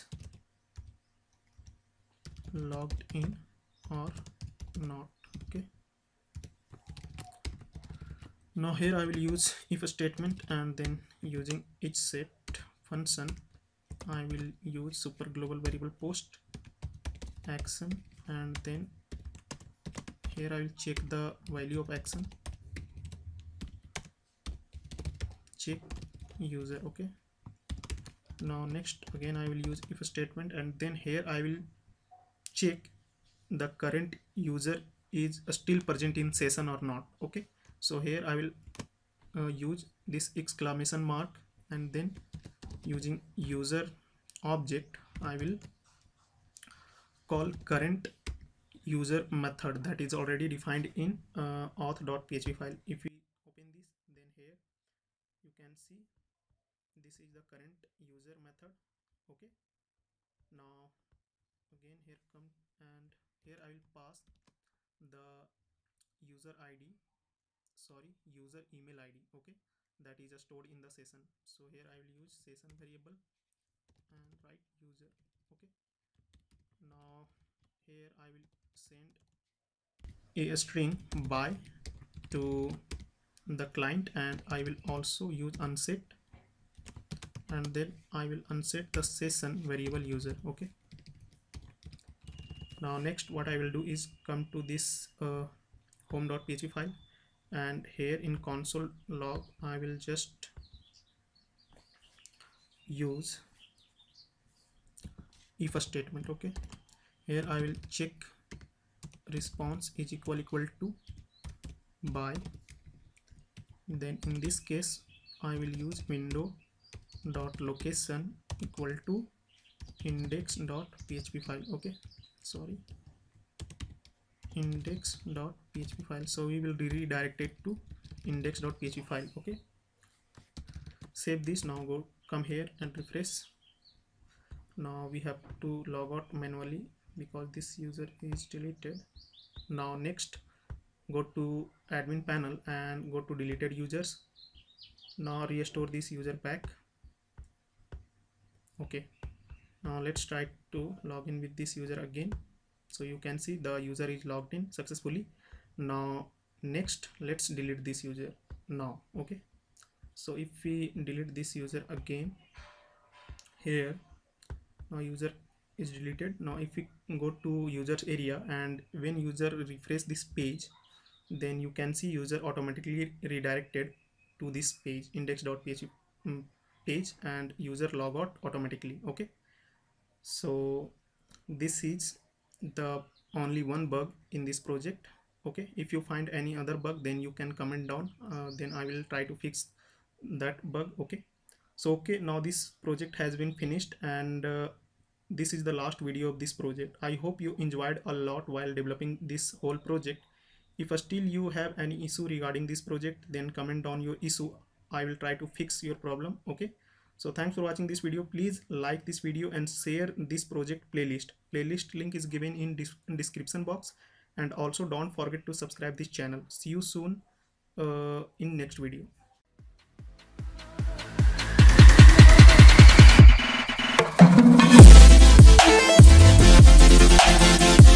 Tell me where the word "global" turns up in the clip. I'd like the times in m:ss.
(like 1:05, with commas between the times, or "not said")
0:15.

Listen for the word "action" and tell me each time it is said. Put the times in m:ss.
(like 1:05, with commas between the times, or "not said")
0:17, 0:21.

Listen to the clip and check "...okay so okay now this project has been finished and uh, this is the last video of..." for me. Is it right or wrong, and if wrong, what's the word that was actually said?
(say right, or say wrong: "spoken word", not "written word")
right.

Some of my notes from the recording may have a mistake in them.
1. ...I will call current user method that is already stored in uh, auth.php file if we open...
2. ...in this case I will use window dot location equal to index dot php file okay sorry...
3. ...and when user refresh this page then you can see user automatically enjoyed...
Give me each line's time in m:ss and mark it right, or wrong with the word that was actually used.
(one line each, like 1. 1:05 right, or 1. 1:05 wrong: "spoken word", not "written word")
1. 0:45 wrong: "defined", not "stored"
2. 1:54 right
3. 2:48 wrong: "redirected", not "enjoyed".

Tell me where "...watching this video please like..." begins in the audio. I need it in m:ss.
3:27.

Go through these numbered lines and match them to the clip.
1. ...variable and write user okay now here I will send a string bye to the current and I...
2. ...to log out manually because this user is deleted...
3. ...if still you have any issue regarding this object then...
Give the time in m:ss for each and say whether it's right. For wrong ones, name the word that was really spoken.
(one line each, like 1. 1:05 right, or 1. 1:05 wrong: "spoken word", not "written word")
1. 1:12 wrong: "client", not "current"
2. 2:15 right
3. 3:20 wrong: "project", not "object".